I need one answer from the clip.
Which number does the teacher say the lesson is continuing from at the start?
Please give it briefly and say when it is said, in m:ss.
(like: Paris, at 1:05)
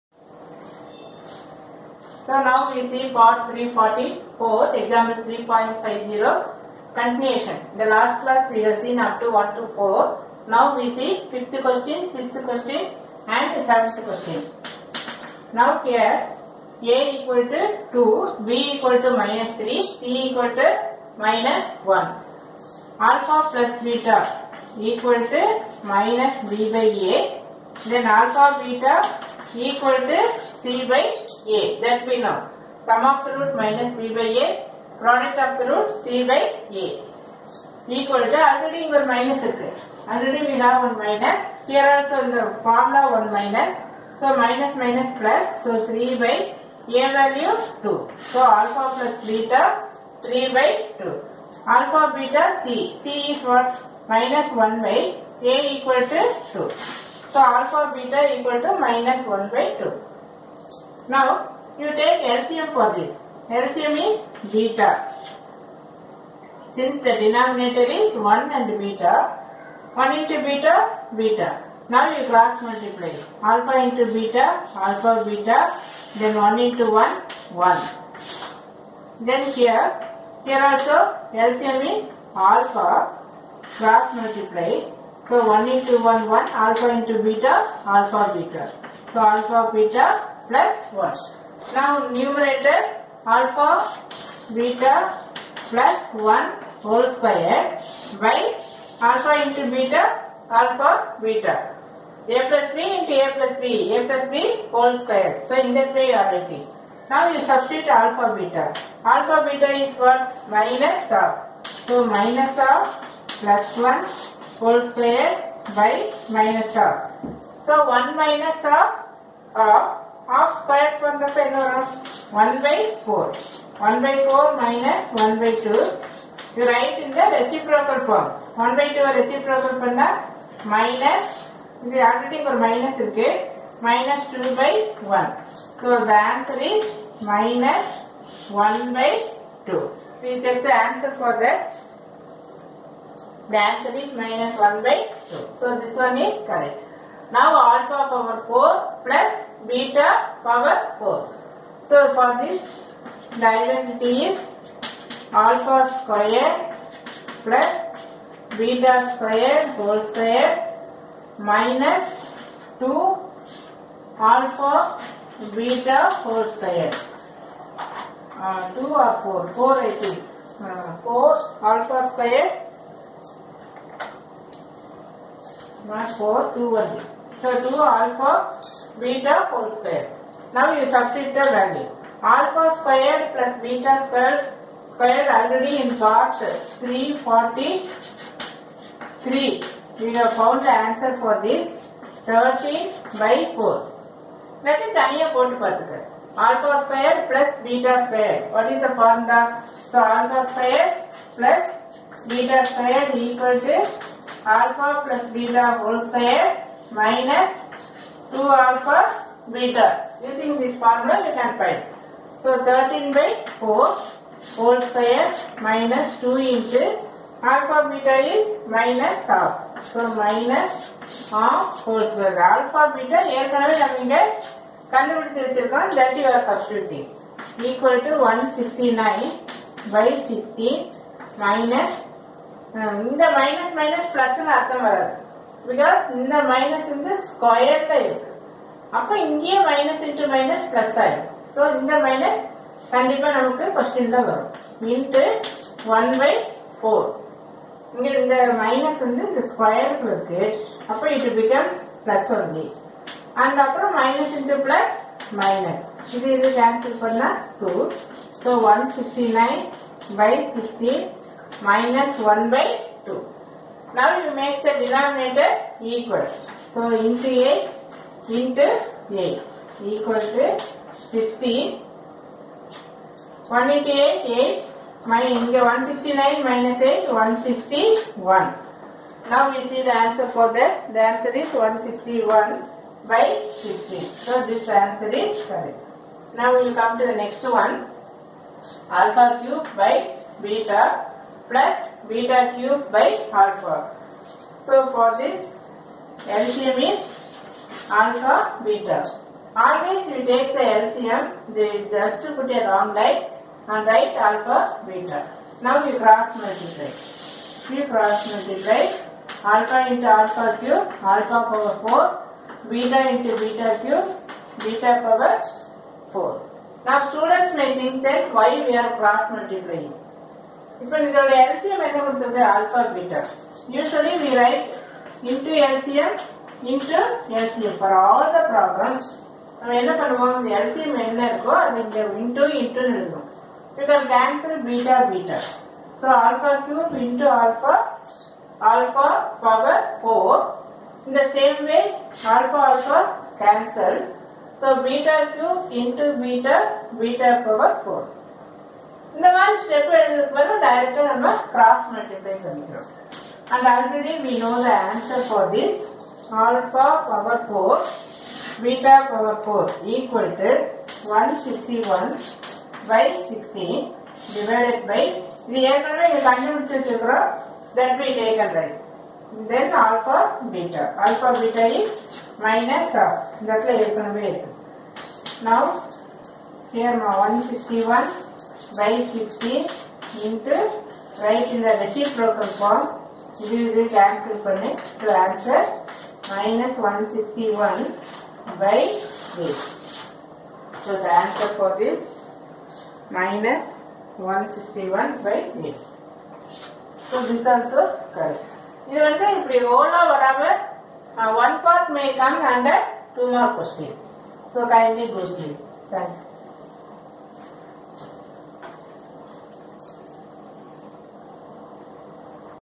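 344, at 0:03.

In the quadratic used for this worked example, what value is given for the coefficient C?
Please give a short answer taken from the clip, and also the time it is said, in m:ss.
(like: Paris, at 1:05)
-1, at 0:19.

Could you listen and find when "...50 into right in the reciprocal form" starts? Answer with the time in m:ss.
6:19.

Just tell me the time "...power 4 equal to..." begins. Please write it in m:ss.
5:59.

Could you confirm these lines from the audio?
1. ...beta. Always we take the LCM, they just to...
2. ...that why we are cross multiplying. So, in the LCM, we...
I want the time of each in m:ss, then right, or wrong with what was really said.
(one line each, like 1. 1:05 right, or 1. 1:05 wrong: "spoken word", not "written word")
1. 4:58 right
2. 5:18 right.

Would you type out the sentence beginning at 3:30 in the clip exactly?
Using this formula you can find.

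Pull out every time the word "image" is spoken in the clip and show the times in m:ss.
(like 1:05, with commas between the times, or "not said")
not said.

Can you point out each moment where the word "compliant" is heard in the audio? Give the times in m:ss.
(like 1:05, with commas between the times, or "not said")
not said.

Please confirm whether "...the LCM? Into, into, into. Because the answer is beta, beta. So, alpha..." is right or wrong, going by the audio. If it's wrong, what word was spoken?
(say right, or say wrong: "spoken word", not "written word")
right.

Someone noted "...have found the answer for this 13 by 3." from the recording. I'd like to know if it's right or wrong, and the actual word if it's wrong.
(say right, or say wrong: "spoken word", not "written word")
wrong: "4", not "3".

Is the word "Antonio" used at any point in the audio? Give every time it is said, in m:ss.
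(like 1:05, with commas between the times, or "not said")
not said.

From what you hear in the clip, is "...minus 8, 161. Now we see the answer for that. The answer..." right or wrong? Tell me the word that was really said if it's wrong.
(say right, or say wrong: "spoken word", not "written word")
right.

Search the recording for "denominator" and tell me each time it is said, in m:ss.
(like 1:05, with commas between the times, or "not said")
1:07, 2:01, 4:24.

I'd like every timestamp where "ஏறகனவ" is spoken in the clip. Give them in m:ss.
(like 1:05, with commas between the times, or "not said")
3:43, 6:05, 6:13.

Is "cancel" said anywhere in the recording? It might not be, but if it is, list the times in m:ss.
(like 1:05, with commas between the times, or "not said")
5:43, 6:23.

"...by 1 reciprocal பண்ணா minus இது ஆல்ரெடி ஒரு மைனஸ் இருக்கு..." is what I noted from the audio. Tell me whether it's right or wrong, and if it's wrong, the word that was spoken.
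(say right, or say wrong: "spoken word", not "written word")
wrong: "2", not "1".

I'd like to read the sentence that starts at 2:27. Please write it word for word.
Now alpha power 4 plus beta power 4.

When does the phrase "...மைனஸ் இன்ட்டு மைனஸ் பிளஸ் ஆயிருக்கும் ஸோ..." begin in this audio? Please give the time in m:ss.
3:59.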